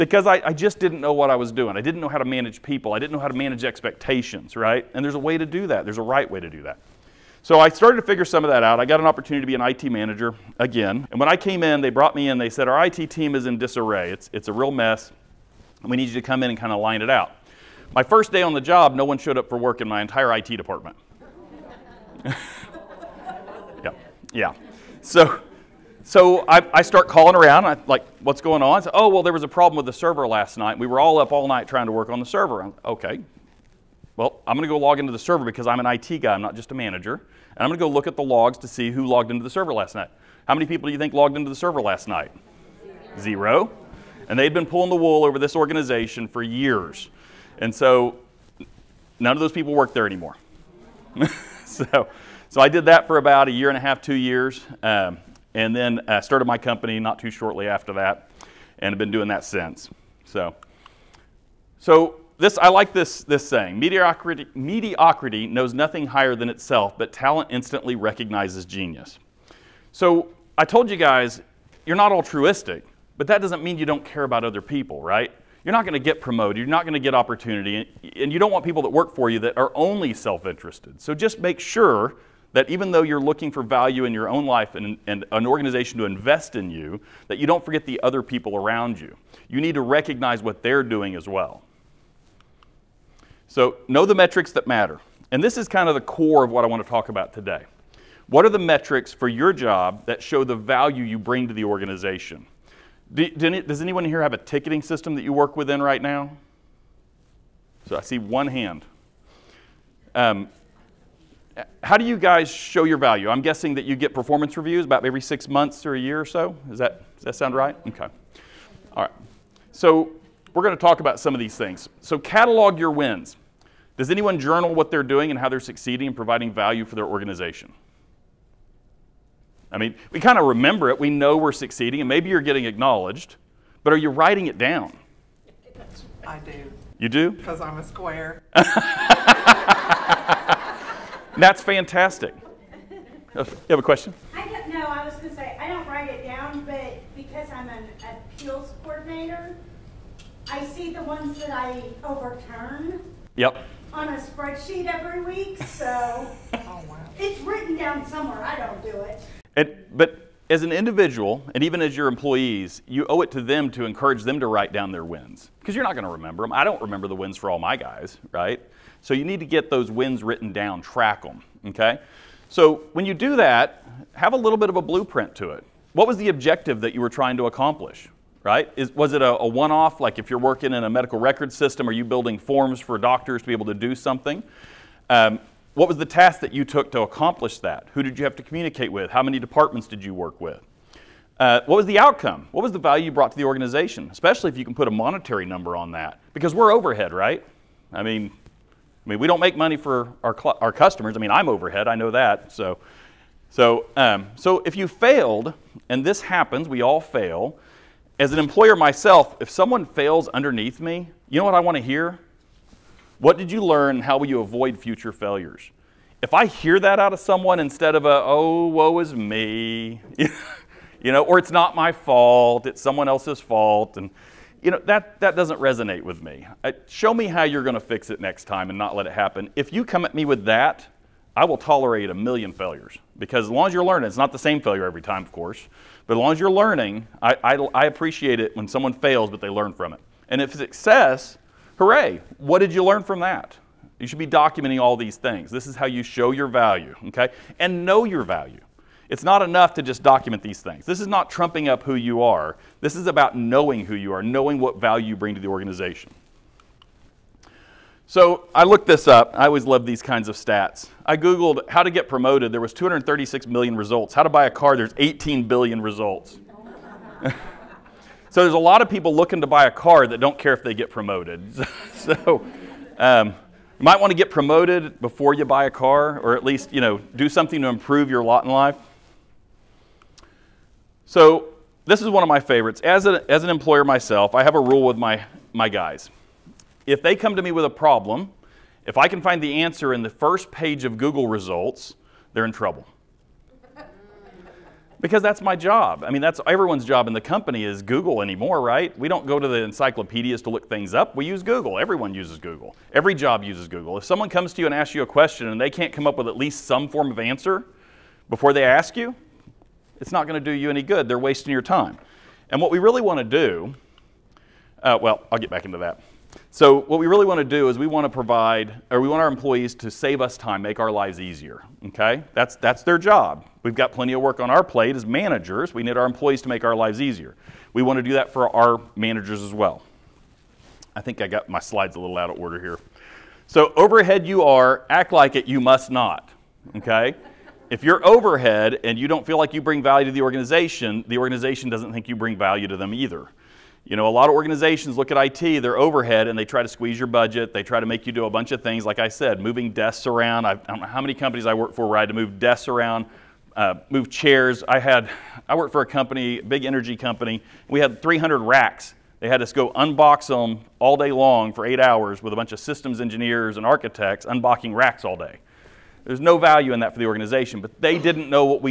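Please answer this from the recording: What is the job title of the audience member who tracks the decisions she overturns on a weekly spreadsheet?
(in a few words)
appeals coordinator.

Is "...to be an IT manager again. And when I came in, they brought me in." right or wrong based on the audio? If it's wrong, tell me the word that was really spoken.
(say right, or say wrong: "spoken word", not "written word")
right.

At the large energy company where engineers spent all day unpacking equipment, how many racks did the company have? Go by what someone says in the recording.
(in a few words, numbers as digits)
300.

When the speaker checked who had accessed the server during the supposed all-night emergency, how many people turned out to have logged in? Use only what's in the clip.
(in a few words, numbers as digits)
0.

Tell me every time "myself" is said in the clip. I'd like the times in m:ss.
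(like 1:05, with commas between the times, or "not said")
3:28, 4:43.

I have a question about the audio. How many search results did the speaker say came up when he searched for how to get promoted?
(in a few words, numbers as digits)
236 million.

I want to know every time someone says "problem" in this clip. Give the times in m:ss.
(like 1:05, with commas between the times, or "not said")
0:29, 4:47.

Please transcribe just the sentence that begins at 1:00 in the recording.
So, so this I like this this saying: mediocrity, mediocrity knows nothing higher than itself, but talent instantly recognizes genius.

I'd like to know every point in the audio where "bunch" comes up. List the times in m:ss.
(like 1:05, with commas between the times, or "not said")
5:48, 6:02.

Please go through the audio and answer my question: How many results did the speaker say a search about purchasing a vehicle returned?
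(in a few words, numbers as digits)
18 billion.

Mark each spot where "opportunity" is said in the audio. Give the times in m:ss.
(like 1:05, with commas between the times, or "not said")
0:09, 1:17.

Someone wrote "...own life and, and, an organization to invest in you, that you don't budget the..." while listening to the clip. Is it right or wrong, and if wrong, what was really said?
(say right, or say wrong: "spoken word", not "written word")
wrong: "forget", not "budget".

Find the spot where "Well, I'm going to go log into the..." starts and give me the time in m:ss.
0:34.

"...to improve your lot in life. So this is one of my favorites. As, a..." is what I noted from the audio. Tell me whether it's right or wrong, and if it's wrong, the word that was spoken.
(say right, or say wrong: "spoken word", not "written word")
right.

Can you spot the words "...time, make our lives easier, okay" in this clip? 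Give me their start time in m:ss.
5:20.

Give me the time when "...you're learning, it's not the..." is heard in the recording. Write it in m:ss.
3:53.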